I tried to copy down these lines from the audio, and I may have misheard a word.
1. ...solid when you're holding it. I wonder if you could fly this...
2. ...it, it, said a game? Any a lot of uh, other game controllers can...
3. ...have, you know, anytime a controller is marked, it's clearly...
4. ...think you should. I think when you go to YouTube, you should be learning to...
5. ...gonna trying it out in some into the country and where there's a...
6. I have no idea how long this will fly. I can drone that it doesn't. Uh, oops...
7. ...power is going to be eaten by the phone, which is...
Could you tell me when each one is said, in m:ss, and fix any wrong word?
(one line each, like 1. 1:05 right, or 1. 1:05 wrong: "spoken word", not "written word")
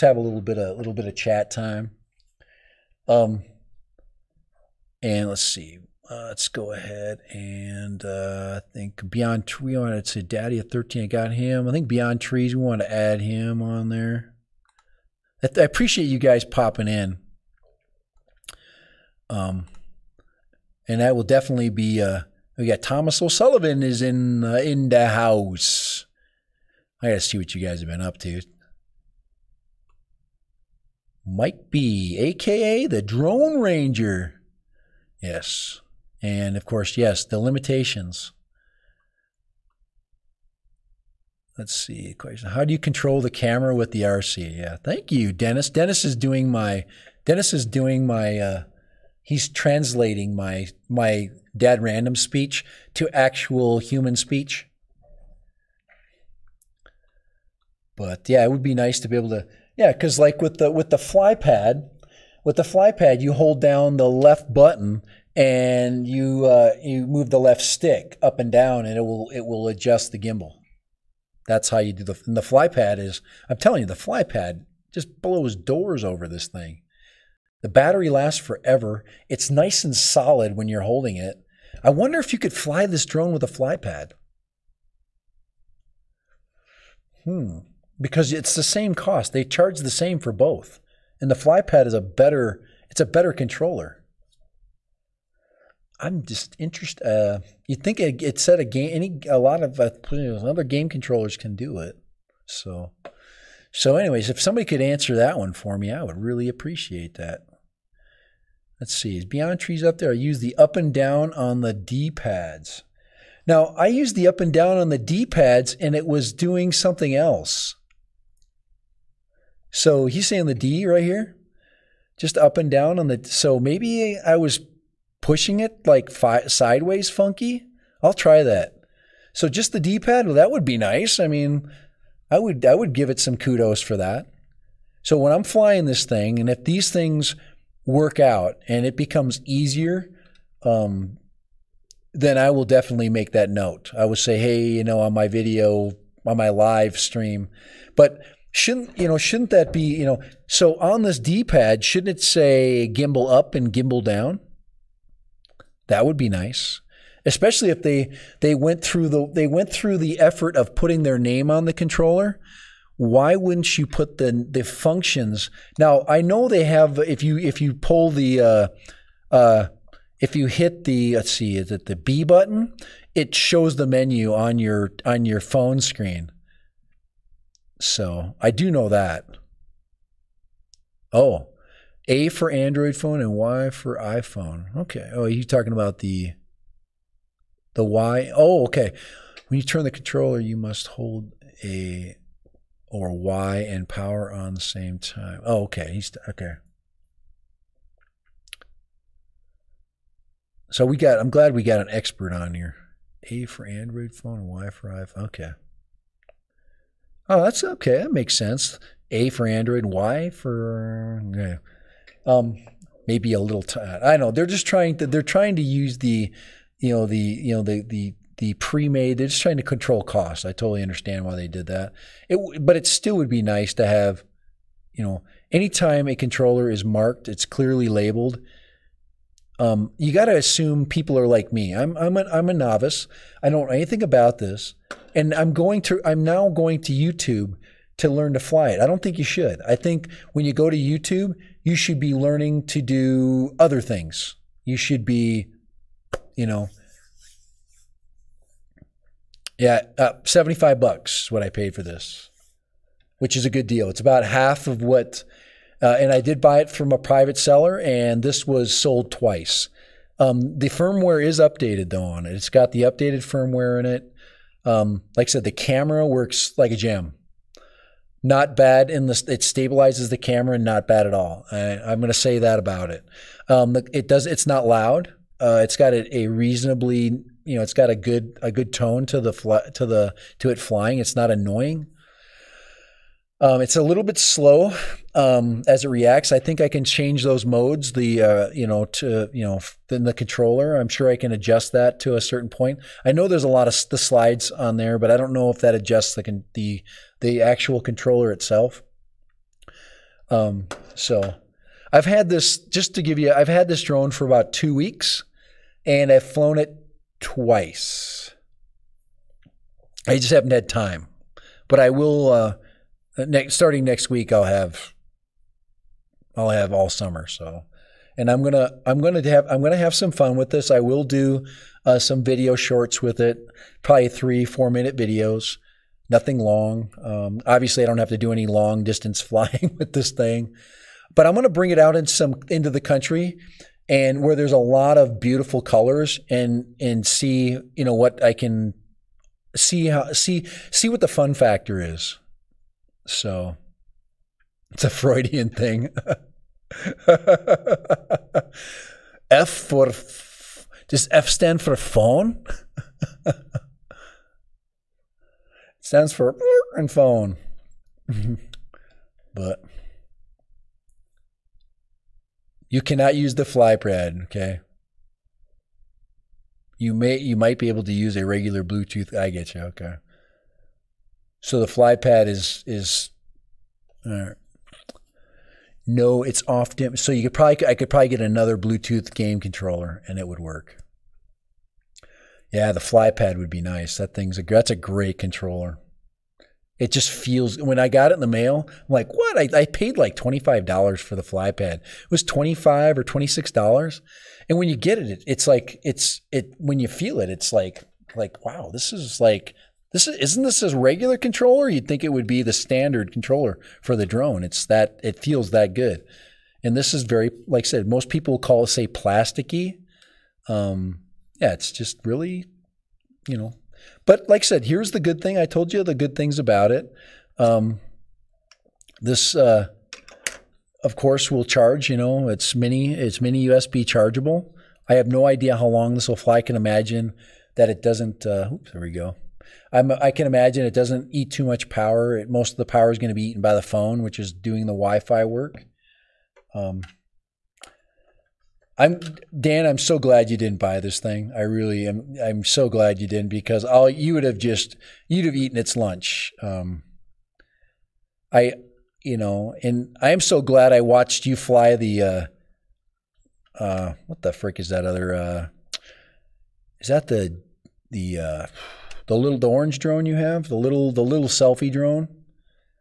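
1. 1:19 right
2. 1:37 right
3. 3:43 right
4. 3:59 right
5. 5:31 wrong: "bring", not "trying"
6. 7:04 wrong: "imagine", not "drone"
7. 7:12 right.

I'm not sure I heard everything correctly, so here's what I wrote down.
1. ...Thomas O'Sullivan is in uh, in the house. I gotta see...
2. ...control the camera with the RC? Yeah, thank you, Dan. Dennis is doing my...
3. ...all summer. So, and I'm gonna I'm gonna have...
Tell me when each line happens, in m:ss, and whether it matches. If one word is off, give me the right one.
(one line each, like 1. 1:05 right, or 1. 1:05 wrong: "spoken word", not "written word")
1. 0:22 right
2. 0:42 wrong: "Dennis", not "Dan"
3. 5:16 right.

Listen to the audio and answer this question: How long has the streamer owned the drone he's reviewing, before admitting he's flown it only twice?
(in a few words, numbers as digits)
About two weeks.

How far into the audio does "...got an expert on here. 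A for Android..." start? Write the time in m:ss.
3:21.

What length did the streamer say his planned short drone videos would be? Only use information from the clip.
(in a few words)
3 to 4 minutes.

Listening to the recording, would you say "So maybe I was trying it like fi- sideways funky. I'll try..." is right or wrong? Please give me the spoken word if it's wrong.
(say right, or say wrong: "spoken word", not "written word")
wrong: "pushing", not "trying".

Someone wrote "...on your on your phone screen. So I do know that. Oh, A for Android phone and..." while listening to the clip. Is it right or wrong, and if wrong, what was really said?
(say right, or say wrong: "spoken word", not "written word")
right.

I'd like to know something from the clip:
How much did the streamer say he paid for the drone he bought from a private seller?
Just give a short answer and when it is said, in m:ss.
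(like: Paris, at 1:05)
$75, at 4:10.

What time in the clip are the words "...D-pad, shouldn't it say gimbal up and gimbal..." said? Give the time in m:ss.
2:31.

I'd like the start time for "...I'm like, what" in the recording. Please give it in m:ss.
6:28.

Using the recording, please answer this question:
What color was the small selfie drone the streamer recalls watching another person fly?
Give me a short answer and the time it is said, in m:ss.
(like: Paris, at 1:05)
Orange, at 7:39.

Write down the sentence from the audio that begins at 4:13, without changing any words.
It's about half of what uh, and I did buy it from a private seller, and this was sold twice.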